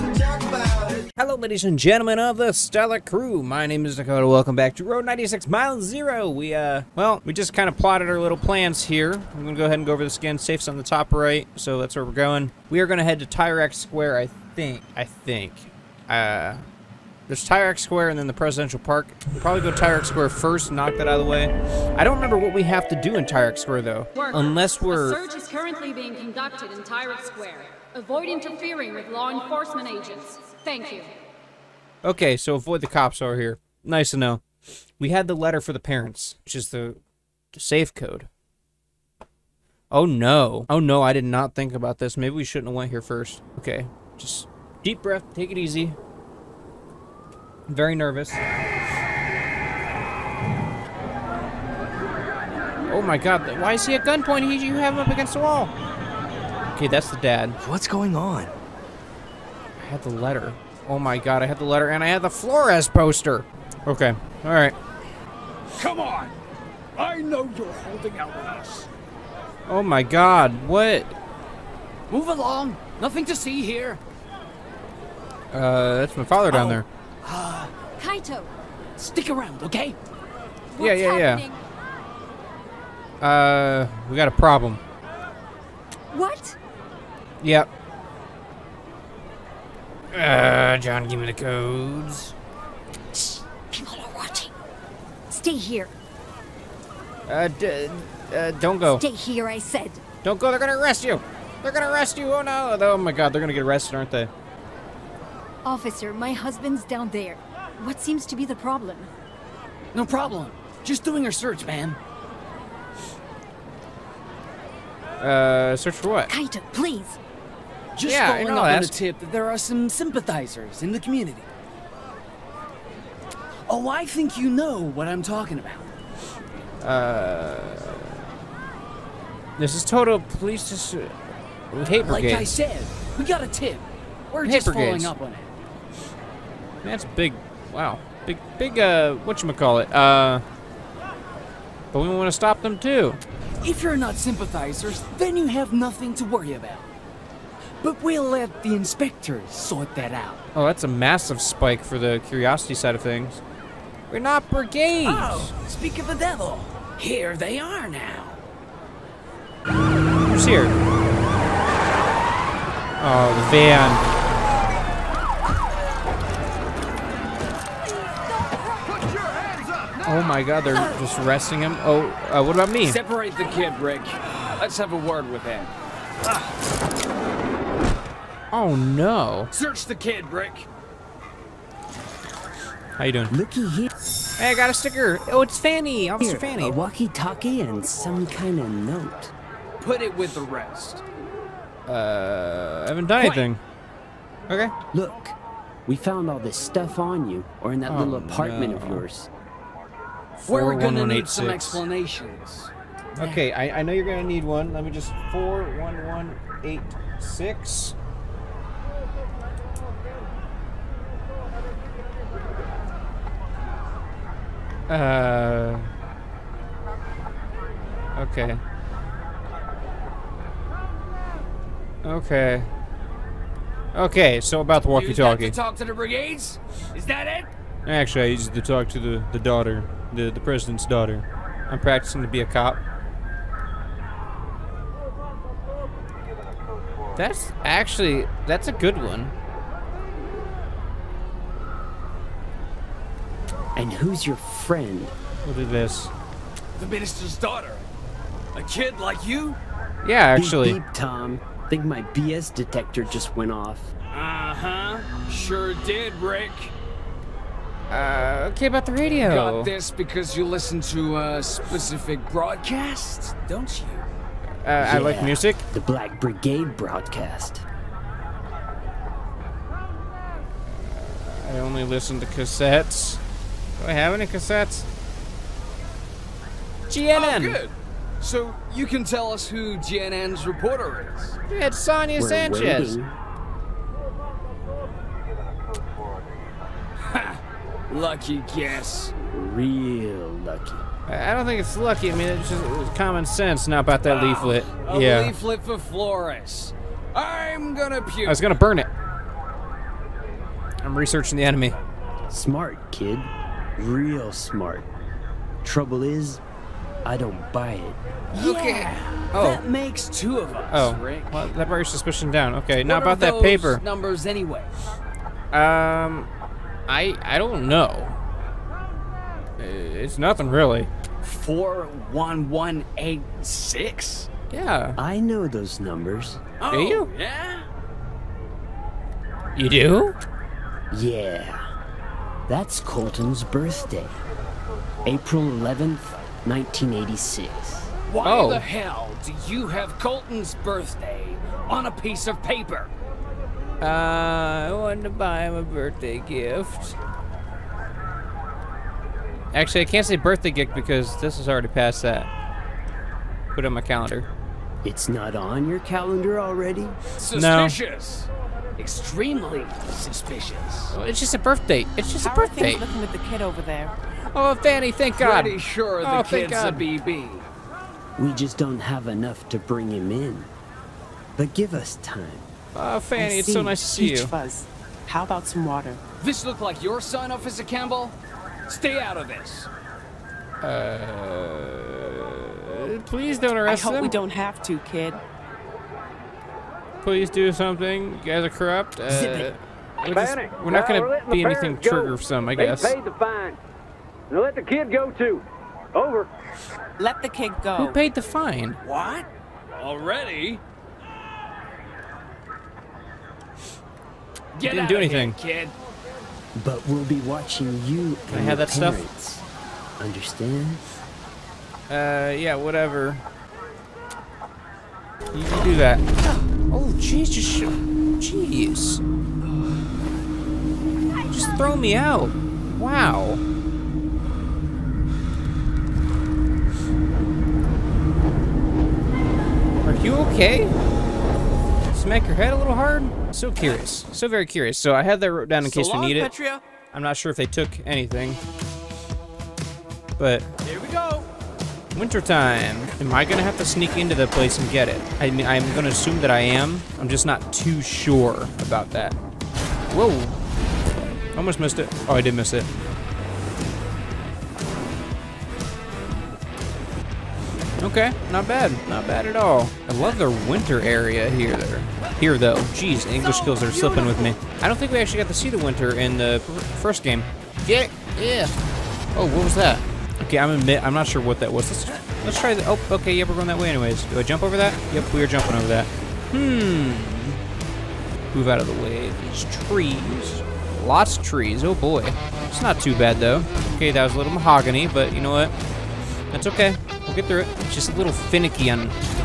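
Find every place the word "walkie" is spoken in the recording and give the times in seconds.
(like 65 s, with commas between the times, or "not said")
186 s, 224 s.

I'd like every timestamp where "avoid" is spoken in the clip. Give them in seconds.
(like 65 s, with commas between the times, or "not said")
27 s, 32 s.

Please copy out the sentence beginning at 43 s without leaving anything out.
Okay, just deep breath, take it easy.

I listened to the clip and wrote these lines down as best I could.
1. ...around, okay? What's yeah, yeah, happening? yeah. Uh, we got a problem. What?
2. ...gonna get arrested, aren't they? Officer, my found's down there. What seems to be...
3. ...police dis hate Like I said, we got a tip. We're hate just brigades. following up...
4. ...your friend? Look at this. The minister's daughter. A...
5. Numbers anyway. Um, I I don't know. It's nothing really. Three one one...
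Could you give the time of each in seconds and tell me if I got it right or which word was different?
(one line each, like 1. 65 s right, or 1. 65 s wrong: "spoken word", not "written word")
1. 79 s right
2. 103 s wrong: "husband", not "found"
3. 130 s right
4. 244 s right
5. 313 s wrong: "Four", not "Three".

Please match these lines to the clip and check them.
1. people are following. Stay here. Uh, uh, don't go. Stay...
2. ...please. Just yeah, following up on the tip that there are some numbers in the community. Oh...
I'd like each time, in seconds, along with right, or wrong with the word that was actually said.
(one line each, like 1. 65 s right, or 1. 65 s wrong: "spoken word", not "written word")
1. 93 s wrong: "watching", not "following"
2. 116 s wrong: "sympathizers", not "numbers".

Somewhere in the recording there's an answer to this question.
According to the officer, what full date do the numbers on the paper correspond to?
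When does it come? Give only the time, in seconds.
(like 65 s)
335 s.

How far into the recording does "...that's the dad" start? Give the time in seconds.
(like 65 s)
56 s.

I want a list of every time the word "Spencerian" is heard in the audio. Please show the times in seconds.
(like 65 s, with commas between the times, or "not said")
not said.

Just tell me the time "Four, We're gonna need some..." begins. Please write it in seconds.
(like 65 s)
200 s.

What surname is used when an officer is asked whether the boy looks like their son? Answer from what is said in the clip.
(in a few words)
Campbell.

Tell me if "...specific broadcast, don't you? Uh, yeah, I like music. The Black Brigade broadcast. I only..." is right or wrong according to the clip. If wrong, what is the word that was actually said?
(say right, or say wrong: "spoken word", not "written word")
right.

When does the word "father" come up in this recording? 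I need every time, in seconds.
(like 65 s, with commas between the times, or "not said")
76 s.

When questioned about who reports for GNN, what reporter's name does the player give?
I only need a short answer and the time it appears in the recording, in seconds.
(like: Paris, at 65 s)
Sonya Sanchez, at 281 s.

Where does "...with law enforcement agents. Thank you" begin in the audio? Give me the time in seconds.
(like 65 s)
28 s.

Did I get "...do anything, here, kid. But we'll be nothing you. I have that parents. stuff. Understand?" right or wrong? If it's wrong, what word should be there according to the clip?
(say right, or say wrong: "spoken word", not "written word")
wrong: "watching", not "nothing".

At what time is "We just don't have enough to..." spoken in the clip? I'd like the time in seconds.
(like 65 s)
368 s.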